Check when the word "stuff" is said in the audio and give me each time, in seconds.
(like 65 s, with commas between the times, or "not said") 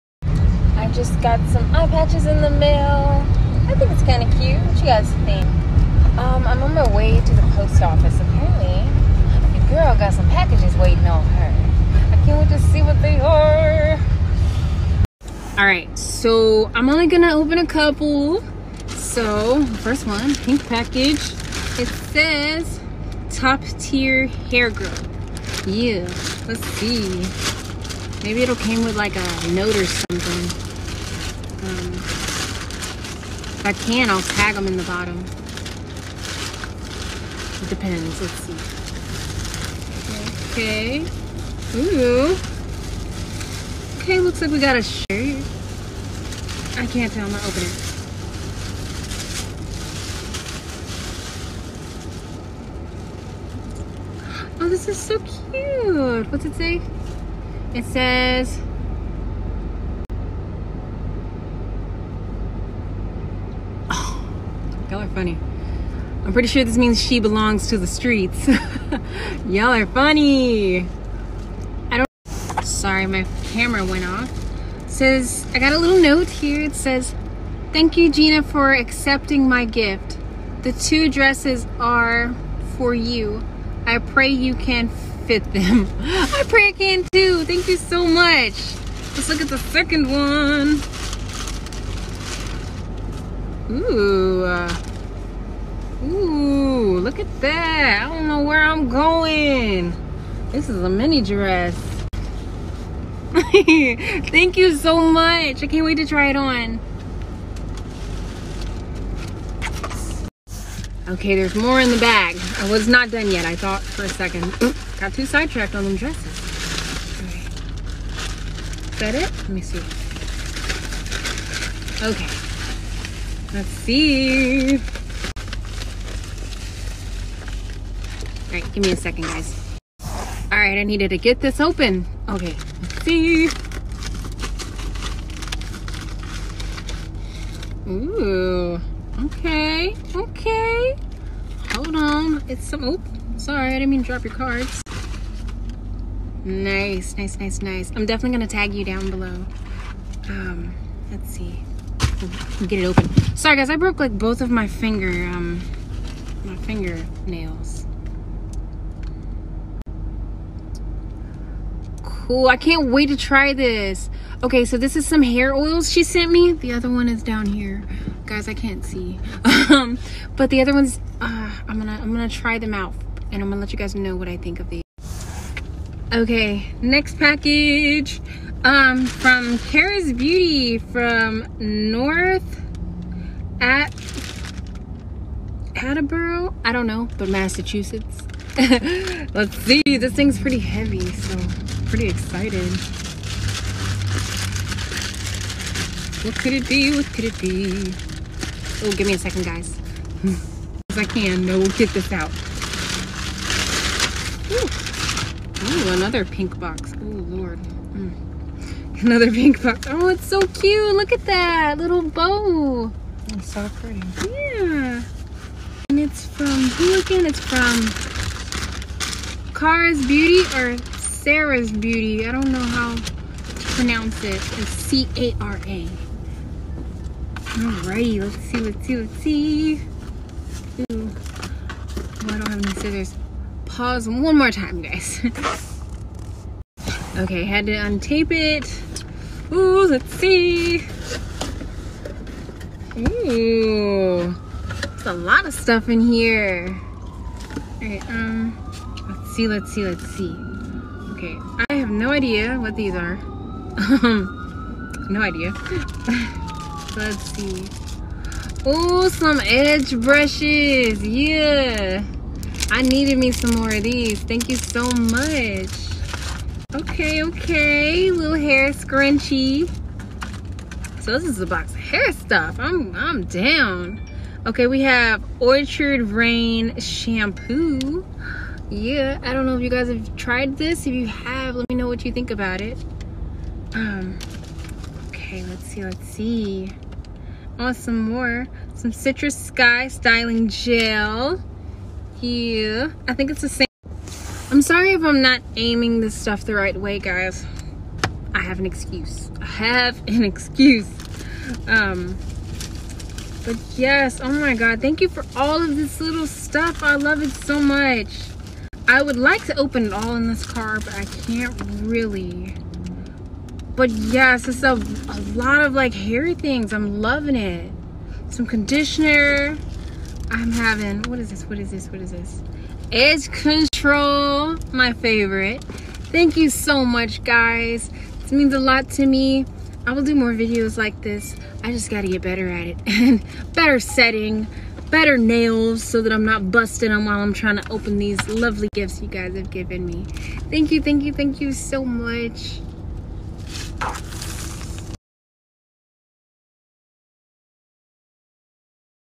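245 s, 272 s, 296 s, 306 s.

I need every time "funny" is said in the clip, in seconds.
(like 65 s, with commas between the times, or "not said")
65 s, 69 s.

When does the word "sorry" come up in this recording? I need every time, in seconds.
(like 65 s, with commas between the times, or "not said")
72 s, 143 s, 153 s, 294 s.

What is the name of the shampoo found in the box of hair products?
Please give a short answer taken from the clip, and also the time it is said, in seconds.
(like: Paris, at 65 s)
Orchard Rain, at 275 s.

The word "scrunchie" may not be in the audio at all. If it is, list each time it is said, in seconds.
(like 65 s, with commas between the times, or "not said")
268 s.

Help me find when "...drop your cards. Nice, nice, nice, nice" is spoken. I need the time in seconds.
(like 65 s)
144 s.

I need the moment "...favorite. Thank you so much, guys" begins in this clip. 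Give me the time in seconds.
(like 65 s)
324 s.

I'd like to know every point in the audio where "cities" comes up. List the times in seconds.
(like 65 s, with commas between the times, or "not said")
not said.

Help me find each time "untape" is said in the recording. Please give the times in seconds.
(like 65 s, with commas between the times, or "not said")
237 s.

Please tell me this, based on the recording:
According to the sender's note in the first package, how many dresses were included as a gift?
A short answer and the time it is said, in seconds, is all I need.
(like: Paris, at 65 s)
2, at 80 s.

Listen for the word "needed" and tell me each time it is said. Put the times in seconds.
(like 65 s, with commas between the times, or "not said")
130 s, 262 s.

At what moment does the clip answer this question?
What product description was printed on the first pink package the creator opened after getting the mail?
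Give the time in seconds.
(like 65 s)
23 s.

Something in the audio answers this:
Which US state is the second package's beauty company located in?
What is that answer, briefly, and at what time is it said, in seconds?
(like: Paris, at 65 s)
Massachusetts, at 187 s.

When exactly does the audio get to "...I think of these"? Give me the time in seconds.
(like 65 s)
174 s.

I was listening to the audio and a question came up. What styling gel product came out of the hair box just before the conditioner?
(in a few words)
Citrus Sky.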